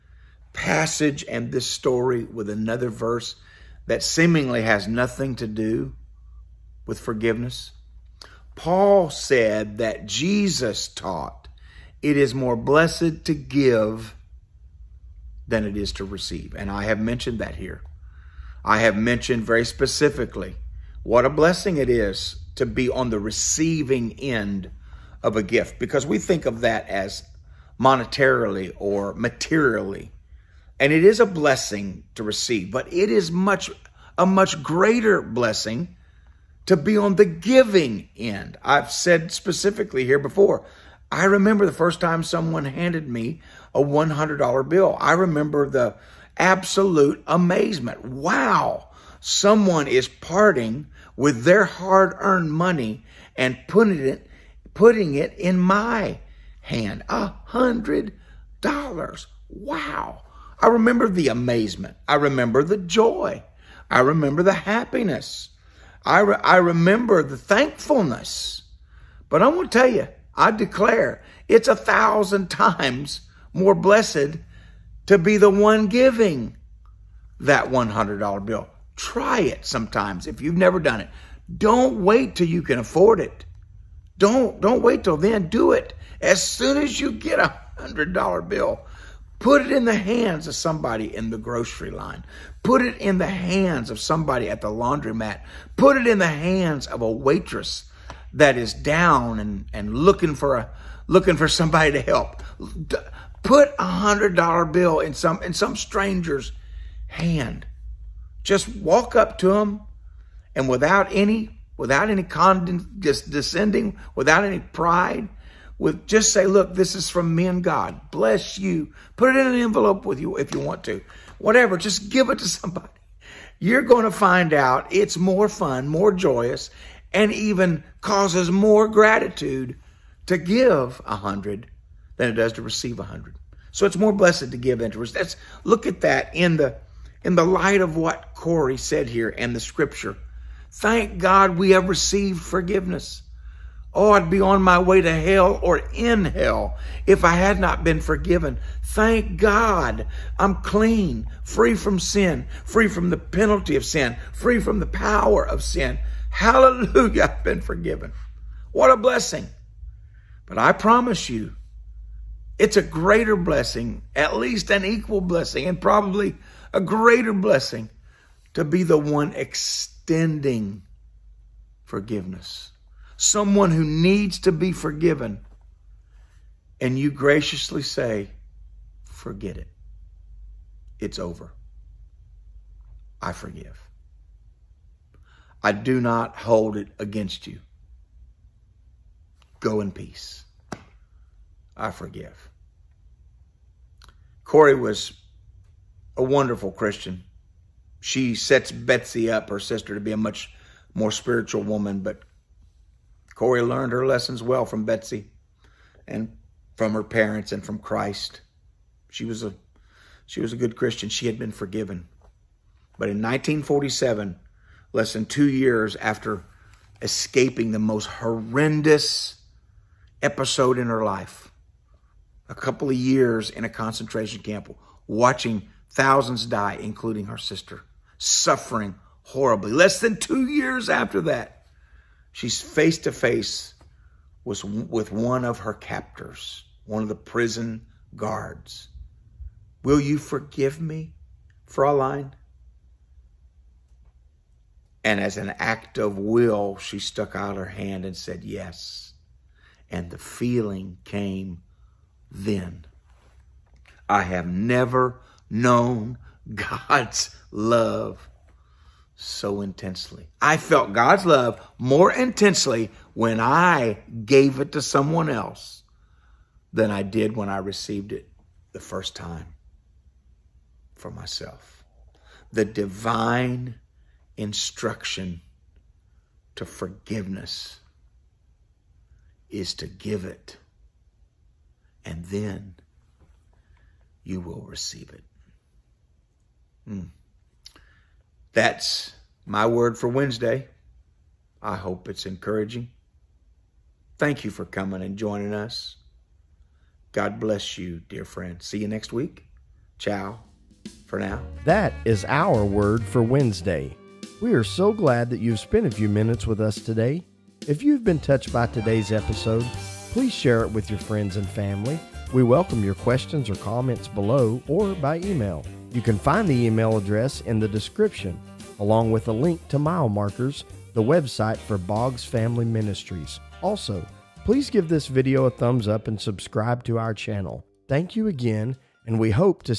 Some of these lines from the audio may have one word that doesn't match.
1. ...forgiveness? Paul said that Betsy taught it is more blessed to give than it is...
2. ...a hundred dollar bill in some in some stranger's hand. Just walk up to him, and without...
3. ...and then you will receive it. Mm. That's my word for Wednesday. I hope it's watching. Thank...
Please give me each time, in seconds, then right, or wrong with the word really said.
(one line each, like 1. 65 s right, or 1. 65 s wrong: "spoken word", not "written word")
1. 6 s wrong: "Jesus", not "Betsy"
2. 103 s right
3. 282 s wrong: "encouraging", not "watching".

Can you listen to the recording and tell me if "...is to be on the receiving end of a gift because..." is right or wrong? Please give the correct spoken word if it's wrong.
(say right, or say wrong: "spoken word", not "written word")
right.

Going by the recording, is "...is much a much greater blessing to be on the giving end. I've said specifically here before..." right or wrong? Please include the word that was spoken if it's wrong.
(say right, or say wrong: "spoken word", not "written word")
right.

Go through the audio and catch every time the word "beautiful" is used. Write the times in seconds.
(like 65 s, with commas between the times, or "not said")
not said.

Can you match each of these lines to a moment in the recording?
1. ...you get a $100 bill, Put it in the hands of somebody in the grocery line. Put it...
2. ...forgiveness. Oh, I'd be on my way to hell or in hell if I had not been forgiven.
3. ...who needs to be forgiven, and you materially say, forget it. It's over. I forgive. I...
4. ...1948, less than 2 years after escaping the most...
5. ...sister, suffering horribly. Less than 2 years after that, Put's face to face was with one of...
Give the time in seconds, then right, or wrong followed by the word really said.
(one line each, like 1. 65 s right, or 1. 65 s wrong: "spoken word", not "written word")
1. 87 s right
2. 142 s right
3. 173 s wrong: "graciously", not "materially"
4. 213 s wrong: "1947", not "1948"
5. 227 s wrong: "She", not "Put".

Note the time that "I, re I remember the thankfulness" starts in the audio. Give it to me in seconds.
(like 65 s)
66 s.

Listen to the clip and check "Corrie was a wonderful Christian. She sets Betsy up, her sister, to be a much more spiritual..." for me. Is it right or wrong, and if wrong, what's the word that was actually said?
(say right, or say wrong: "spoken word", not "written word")
right.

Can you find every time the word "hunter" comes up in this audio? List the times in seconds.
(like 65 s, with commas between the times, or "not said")
not said.